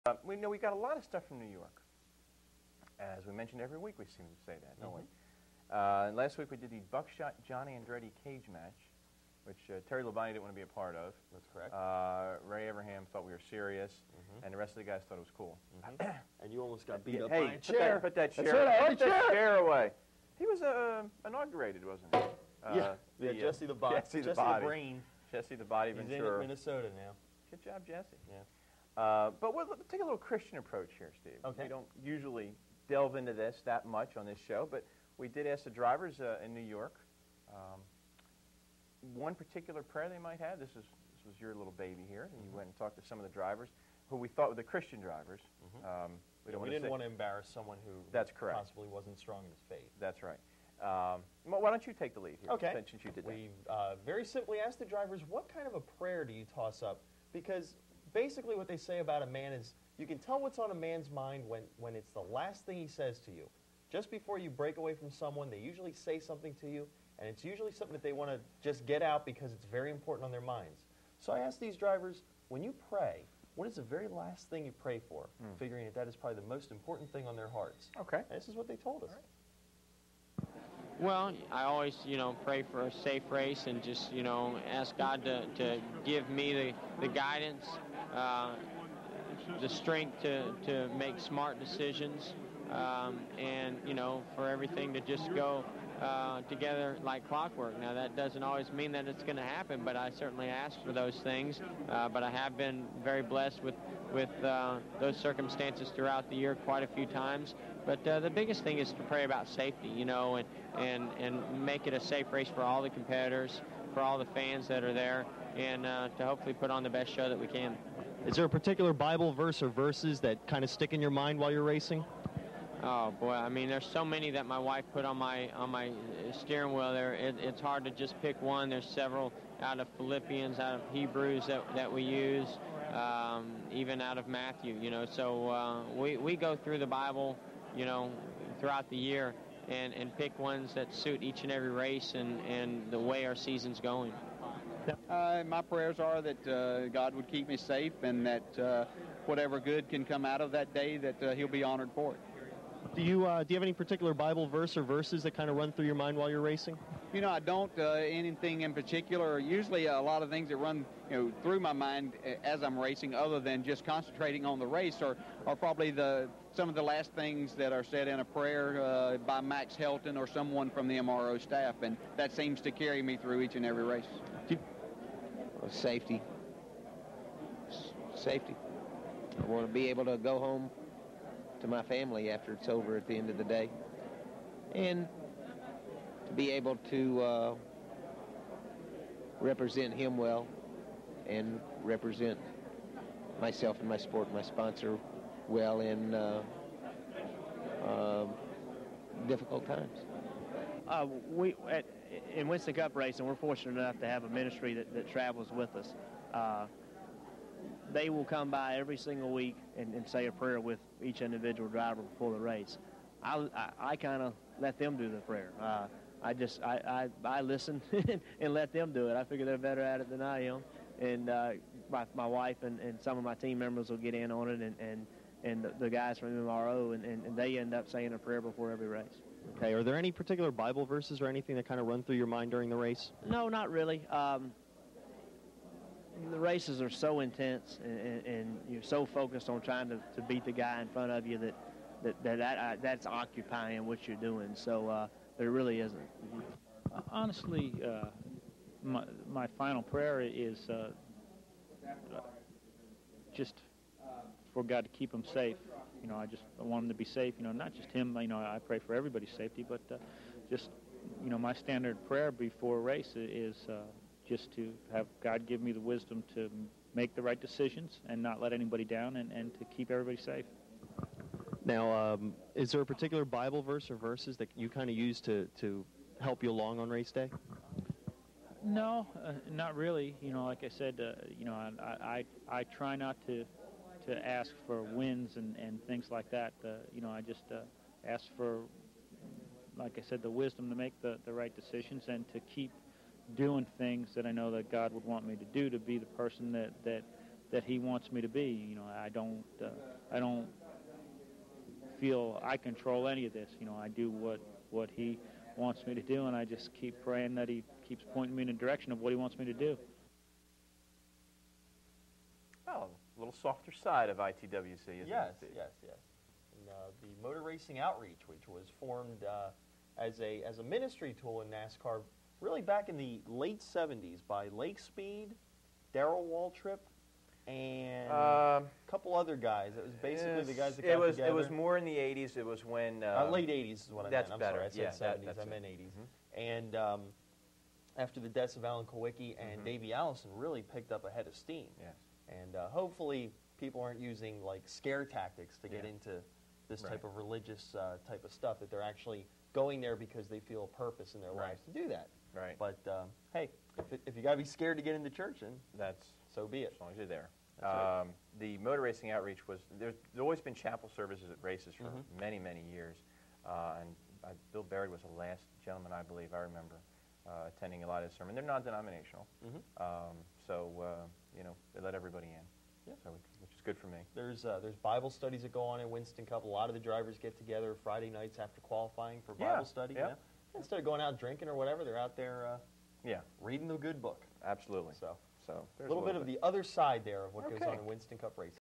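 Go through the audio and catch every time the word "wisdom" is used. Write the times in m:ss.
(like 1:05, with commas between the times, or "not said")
4:25, 4:50.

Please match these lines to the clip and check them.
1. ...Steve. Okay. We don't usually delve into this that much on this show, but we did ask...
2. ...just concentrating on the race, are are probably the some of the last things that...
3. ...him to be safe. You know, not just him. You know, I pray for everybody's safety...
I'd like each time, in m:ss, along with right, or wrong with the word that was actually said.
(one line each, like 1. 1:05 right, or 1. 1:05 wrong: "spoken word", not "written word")
1. 0:31 right
2. 2:43 right
3. 4:16 right.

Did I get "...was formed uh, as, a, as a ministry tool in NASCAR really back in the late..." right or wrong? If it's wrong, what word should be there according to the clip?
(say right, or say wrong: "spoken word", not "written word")
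right.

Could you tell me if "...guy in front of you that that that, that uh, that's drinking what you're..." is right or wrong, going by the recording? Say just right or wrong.
wrong.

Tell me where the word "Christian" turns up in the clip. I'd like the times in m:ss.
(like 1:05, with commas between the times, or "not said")
0:30, 0:44.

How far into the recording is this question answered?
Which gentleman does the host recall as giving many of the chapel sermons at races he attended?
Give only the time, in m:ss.
6:04.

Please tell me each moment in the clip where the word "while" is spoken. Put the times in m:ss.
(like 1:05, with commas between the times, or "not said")
2:01, 2:36.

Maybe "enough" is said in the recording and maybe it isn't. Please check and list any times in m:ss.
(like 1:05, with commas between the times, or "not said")
3:23.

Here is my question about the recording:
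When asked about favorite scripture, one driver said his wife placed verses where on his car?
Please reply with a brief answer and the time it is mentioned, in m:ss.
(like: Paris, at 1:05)
steering wheel, at 2:06.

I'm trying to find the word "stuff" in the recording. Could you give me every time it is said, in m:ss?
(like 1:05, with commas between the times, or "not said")
0:01, 5:48.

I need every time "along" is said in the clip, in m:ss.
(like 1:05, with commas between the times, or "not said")
4:36.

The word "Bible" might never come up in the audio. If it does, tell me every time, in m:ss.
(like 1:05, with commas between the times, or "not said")
1:58, 2:16, 2:34, 3:50, 4:33, 6:14, 6:19.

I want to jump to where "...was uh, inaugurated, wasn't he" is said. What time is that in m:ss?
0:20.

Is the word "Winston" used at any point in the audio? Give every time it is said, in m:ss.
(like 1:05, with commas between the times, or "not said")
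3:22, 6:15, 6:27.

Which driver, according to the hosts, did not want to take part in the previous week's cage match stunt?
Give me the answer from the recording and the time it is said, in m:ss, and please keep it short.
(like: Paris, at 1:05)
Terry Labonte, at 0:09.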